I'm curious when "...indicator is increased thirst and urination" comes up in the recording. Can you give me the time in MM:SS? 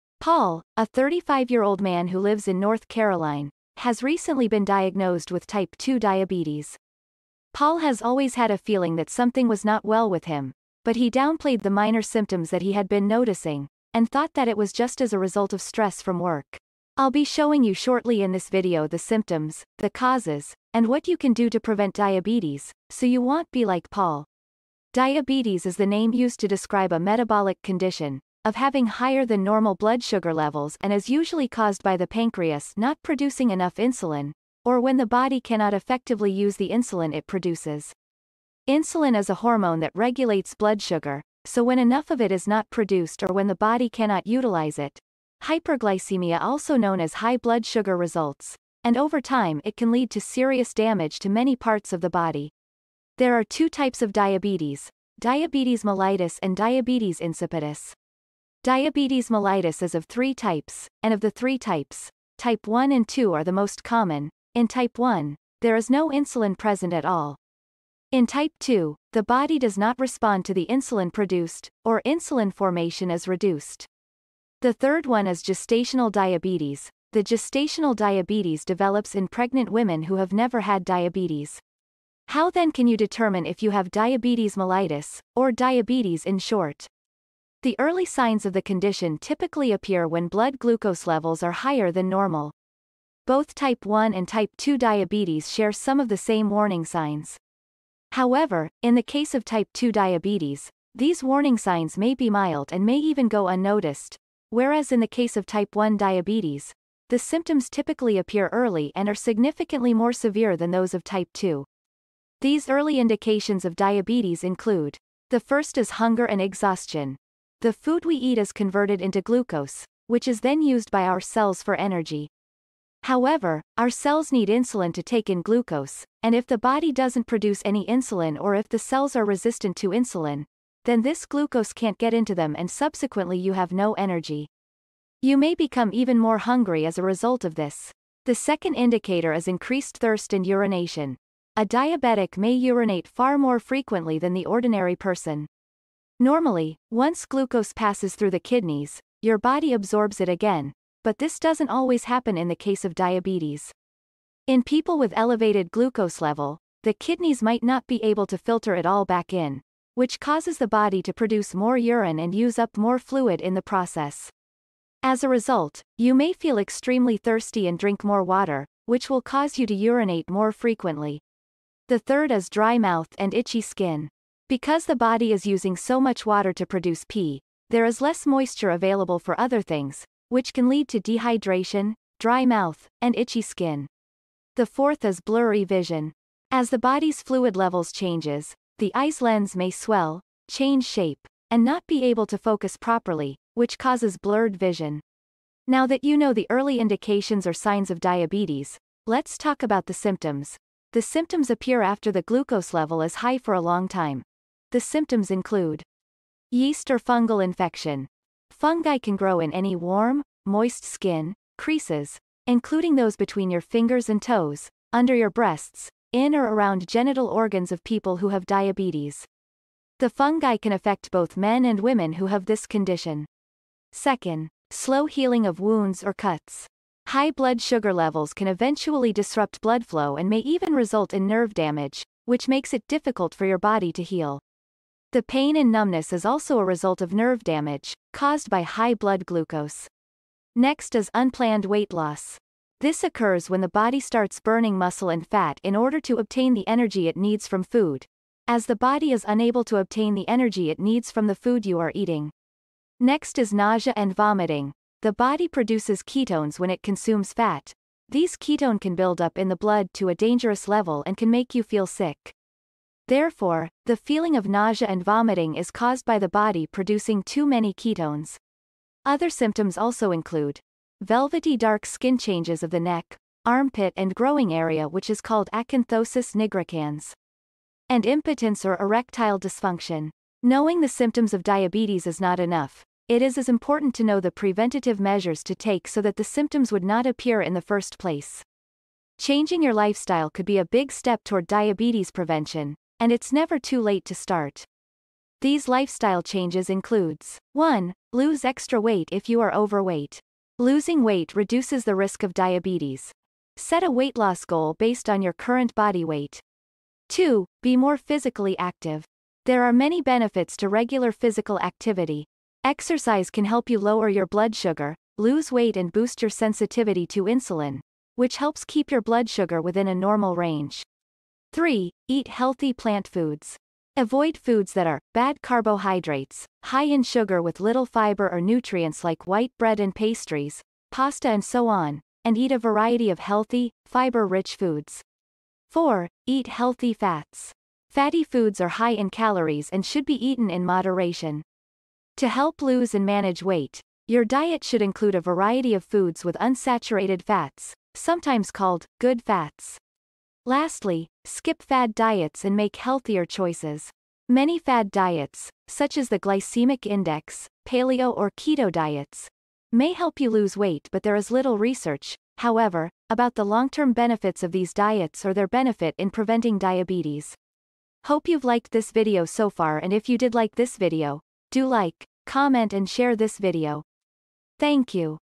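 02:18.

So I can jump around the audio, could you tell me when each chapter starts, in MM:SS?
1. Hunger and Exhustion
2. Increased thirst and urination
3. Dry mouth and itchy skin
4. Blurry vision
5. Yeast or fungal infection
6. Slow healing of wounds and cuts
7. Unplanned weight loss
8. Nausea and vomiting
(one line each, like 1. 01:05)
1. 01:55
2. 02:18
3. 02:50
4. 03:04
5. 03:26
6. 03:45
7. 04:00
8. 04:14.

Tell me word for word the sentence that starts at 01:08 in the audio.
In type 2, the body does not respond to the insulin produced, or insulin formation is reduced.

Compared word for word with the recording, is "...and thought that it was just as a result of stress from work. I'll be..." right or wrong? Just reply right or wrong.
right.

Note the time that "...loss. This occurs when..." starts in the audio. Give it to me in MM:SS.
04:01.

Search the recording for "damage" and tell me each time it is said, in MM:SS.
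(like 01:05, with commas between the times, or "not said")
00:50, 03:51, 03:57.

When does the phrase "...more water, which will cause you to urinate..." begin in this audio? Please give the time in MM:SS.
02:48.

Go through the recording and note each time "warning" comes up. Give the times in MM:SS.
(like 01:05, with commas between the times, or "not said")
01:36, 01:41.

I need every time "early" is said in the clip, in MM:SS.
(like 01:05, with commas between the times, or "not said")
01:27, 01:48, 01:52, 03:16.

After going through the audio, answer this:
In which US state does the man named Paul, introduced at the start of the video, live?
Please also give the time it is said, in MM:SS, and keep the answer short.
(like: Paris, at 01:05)
North Carolina, at 00:02.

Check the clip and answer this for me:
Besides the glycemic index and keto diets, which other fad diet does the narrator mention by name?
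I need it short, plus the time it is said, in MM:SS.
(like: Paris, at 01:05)
paleo, at 05:57.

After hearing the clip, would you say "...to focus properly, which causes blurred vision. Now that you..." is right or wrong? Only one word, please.
right.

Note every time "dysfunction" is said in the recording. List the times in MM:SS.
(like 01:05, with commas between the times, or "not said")
04:39.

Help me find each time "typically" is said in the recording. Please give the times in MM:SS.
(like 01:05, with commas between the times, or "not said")
01:29, 01:47.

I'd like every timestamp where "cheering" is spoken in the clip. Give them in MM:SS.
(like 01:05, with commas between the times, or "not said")
not said.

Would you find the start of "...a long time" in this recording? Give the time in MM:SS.
03:23.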